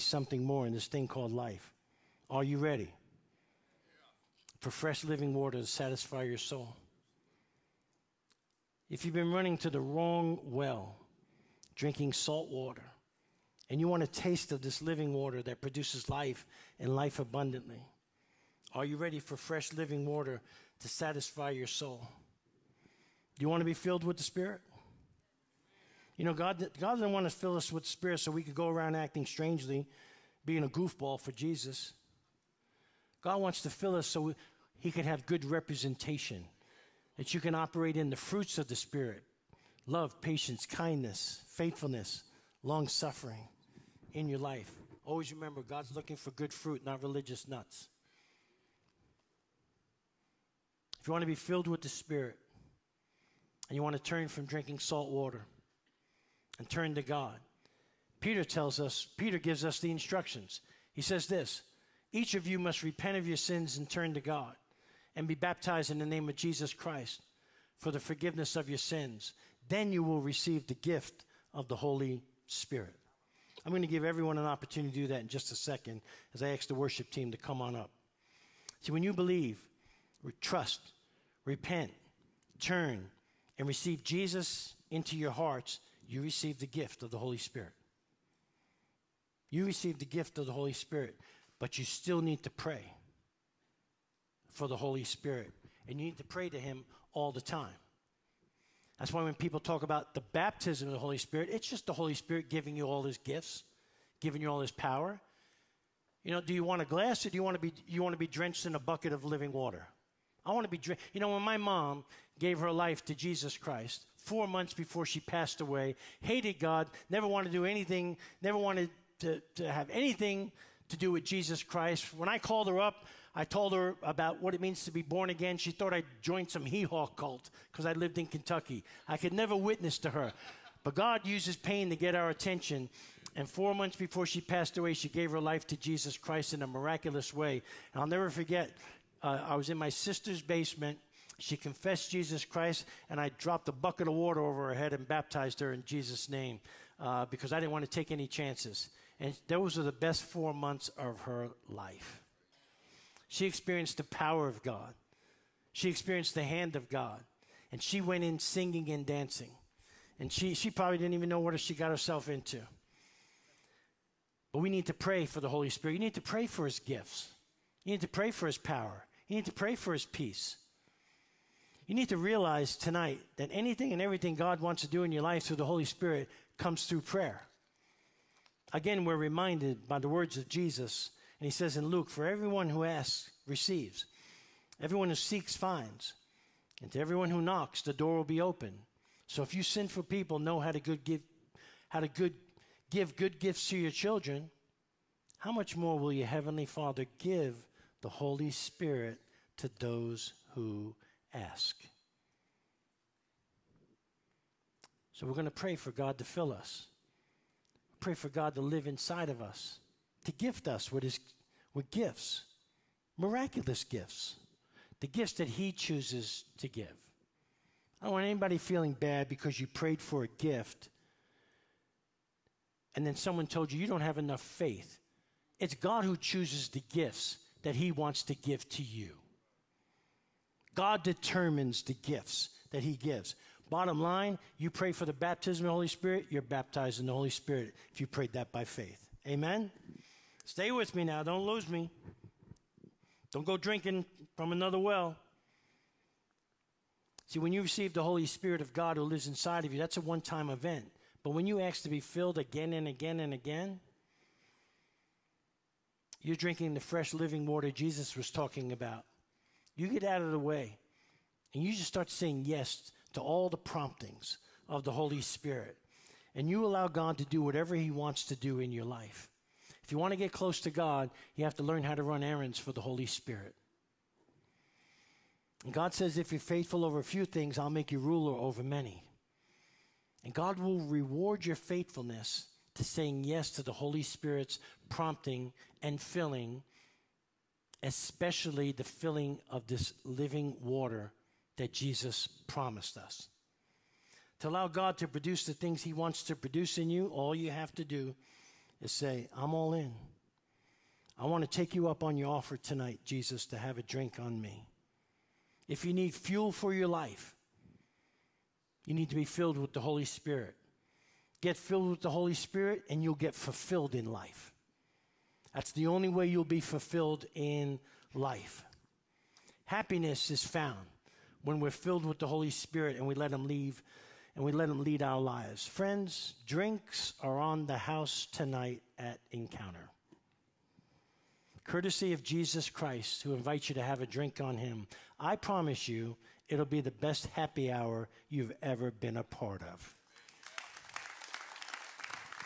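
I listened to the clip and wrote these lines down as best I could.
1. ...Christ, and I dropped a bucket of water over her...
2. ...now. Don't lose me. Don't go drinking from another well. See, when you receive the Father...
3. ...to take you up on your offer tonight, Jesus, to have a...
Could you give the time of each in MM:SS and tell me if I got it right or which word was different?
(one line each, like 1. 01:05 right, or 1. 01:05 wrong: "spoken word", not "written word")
1. 02:22 right
2. 04:01 wrong: "Holy", not "Father"
3. 05:01 right.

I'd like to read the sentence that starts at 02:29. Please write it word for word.
And those were the best four months of her life.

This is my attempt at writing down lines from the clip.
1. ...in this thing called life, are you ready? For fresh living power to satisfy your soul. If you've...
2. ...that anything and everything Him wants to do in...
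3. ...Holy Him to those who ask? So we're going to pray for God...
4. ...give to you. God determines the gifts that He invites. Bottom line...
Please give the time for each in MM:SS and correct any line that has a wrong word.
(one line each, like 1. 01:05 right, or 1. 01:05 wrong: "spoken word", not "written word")
1. 00:00 wrong: "water", not "power"
2. 02:53 wrong: "God", not "Him"
3. 03:18 wrong: "Spirit", not "Him"
4. 03:48 wrong: "gives", not "invites".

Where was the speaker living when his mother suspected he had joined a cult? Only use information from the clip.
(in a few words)
Kentucky.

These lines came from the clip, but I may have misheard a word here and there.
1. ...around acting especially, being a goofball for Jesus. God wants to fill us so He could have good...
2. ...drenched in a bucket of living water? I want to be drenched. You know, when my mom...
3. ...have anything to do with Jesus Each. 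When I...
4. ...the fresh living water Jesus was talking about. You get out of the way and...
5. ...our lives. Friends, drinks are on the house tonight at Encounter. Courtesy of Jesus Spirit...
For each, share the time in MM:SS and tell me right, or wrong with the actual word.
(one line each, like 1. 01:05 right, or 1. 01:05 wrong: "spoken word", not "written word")
1. 00:28 wrong: "strangely", not "especially"
2. 01:48 right
3. 01:59 wrong: "Christ", not "Each"
4. 04:16 right
5. 05:25 wrong: "Christ", not "Spirit".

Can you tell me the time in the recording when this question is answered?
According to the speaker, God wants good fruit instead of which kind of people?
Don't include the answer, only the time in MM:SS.
00:47.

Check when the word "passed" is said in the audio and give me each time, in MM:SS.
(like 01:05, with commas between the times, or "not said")
01:55, 02:14.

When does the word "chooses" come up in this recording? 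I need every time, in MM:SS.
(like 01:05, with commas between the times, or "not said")
03:35, 03:46.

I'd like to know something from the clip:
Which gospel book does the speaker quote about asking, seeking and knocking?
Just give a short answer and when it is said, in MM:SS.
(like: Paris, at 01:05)
Luke, at 03:01.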